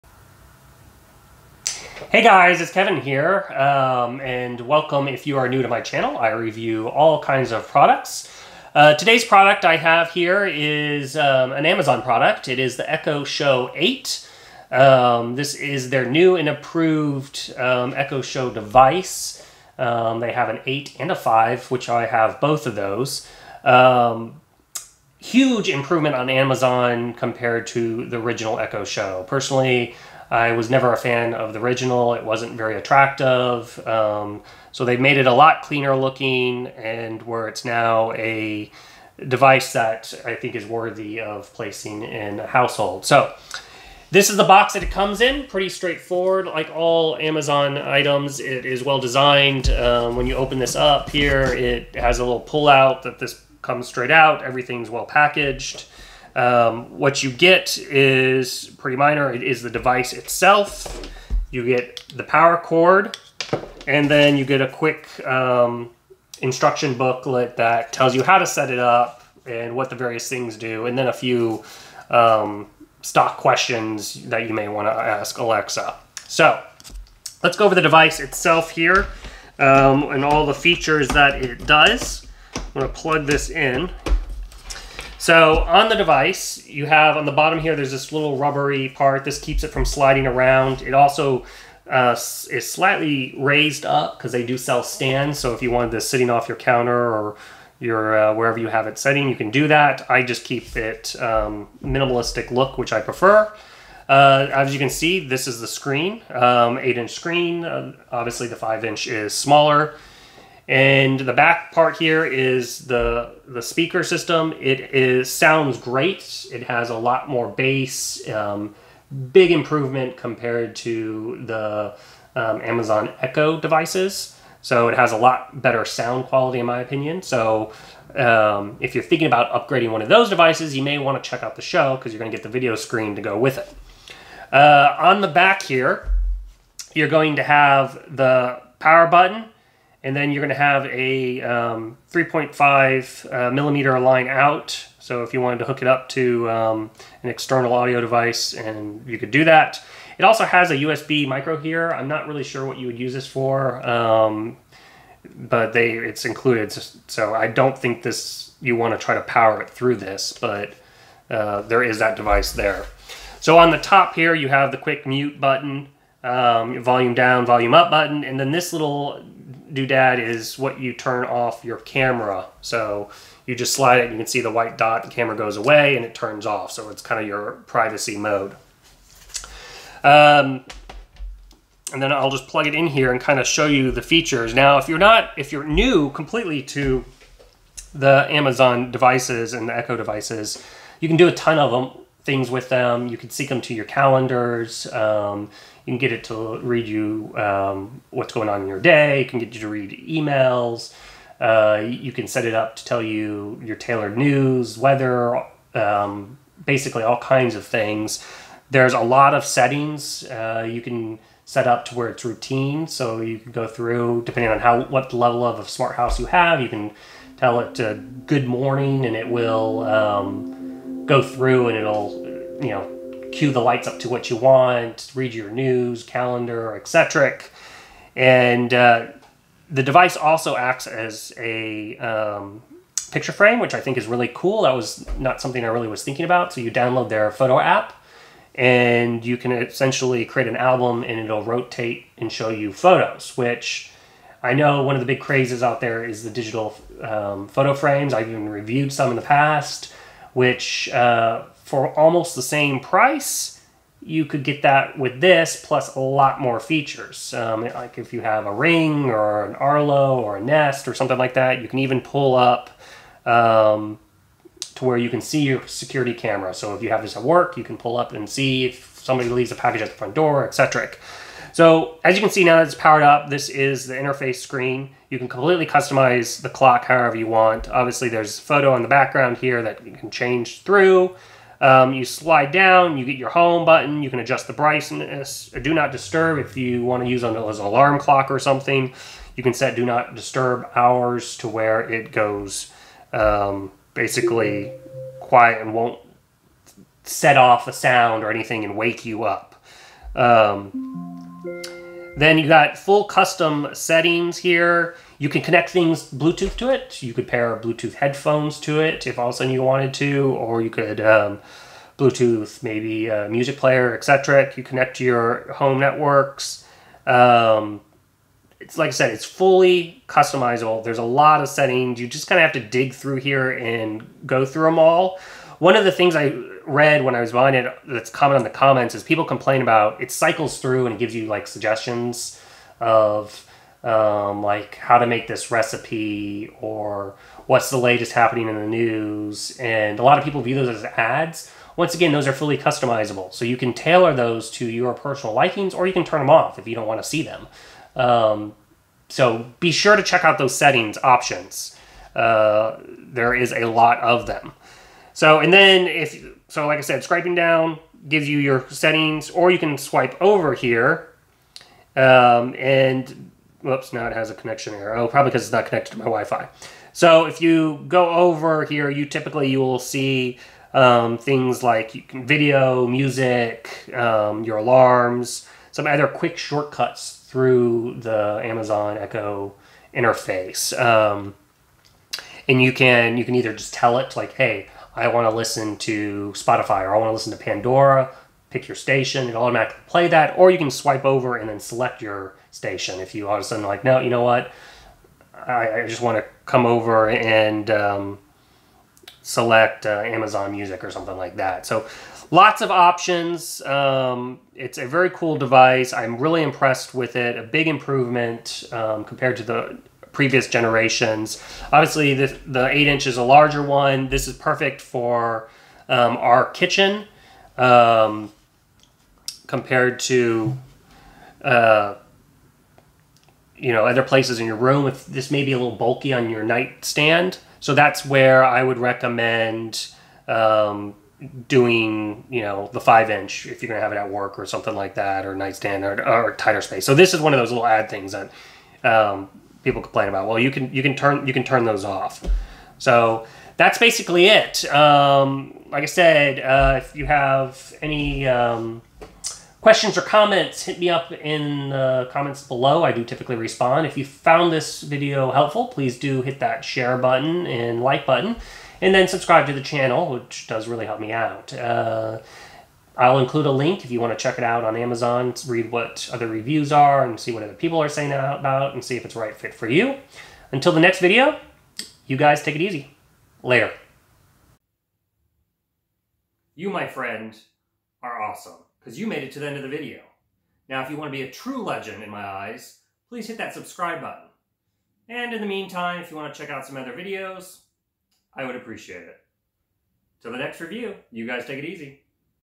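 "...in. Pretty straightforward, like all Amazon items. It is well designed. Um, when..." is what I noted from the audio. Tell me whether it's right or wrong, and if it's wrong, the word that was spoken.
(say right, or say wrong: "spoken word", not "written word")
right.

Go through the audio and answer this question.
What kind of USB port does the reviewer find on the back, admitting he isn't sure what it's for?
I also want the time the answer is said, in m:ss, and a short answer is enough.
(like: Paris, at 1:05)
USB micro, at 2:30.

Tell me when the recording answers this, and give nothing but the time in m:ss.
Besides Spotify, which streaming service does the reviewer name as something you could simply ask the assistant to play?
6:27.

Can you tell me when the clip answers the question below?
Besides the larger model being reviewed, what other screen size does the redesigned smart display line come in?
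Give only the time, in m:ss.
0:21.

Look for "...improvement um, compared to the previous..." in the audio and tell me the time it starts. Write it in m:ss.
6:47.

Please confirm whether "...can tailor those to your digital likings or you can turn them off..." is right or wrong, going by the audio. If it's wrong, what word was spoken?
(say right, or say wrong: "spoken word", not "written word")
wrong: "personal", not "digital".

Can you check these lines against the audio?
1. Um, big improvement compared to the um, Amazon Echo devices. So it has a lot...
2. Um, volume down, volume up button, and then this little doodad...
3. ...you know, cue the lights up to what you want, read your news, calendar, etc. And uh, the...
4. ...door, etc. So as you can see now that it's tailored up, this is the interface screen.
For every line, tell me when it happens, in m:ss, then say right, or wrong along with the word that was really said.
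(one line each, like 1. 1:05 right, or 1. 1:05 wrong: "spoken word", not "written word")
1. 1:58 right
2. 2:46 right
3. 3:42 right
4. 4:30 wrong: "powered", not "tailored".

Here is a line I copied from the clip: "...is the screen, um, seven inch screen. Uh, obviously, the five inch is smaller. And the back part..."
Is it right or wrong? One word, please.
wrong.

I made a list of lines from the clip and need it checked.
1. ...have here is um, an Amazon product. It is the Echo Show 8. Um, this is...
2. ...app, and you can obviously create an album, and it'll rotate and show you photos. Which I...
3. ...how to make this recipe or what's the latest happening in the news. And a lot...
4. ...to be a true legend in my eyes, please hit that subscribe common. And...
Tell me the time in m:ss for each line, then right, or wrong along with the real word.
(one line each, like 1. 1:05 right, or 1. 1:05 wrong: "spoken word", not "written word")
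1. 0:09 right
2. 3:57 wrong: "essentially", not "obviously"
3. 5:34 right
4. 8:01 wrong: "button", not "common".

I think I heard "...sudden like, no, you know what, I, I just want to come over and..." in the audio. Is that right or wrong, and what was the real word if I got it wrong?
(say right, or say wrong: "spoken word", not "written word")
right.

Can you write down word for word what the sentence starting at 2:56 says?
So it's kind of your privacy mode.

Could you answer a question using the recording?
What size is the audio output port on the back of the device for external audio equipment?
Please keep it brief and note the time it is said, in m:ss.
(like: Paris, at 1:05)
3.5 millimeter, at 2:22.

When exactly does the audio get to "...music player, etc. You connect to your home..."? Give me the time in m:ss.
5:13.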